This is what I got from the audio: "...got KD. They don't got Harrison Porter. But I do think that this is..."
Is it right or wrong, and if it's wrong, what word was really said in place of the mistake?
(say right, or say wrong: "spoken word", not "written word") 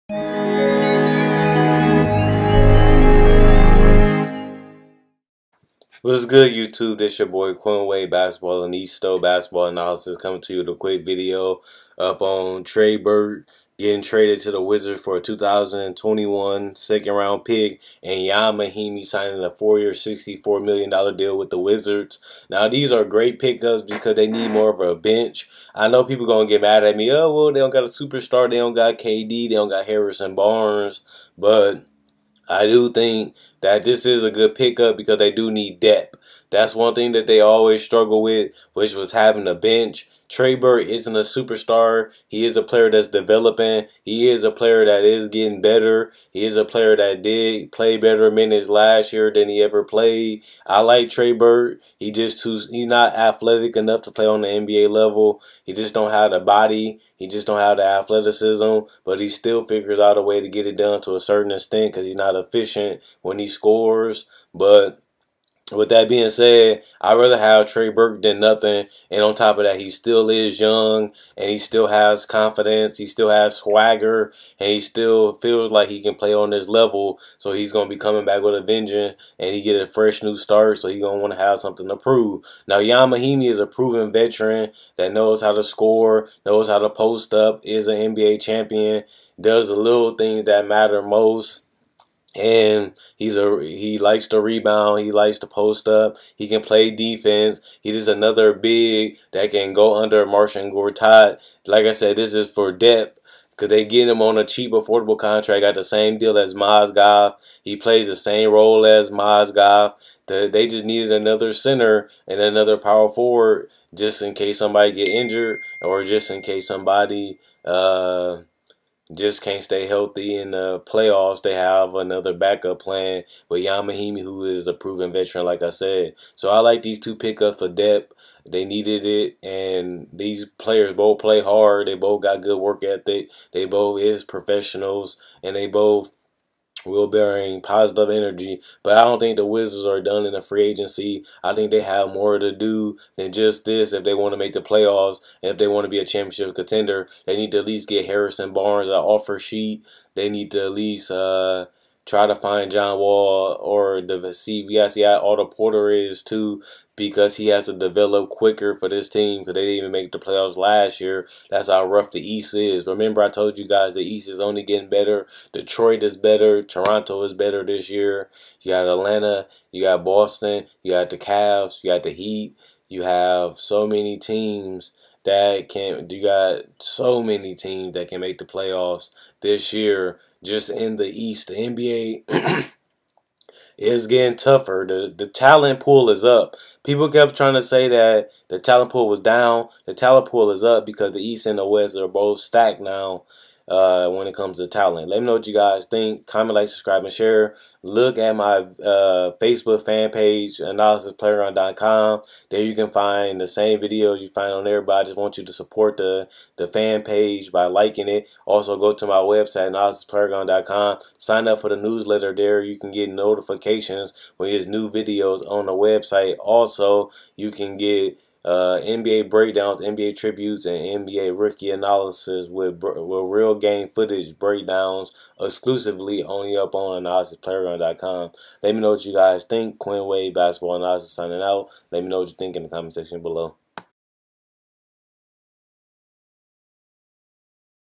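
wrong: "Barnes", not "Porter".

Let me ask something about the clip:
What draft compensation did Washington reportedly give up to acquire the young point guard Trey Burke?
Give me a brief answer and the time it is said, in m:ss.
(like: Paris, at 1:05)
2021 second round pick, at 0:15.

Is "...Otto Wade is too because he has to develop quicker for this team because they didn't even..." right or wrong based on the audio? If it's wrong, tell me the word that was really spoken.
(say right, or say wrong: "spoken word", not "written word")
wrong: "Porter", not "Wade".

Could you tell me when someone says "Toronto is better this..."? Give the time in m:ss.
2:46.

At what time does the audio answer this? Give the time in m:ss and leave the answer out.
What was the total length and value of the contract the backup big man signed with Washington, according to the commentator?
0:19.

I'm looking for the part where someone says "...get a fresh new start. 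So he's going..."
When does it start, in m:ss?
1:19.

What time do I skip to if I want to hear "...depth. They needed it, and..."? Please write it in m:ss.
2:07.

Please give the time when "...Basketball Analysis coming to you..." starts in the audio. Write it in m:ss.
0:09.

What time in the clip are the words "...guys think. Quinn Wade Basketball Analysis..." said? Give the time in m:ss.
3:49.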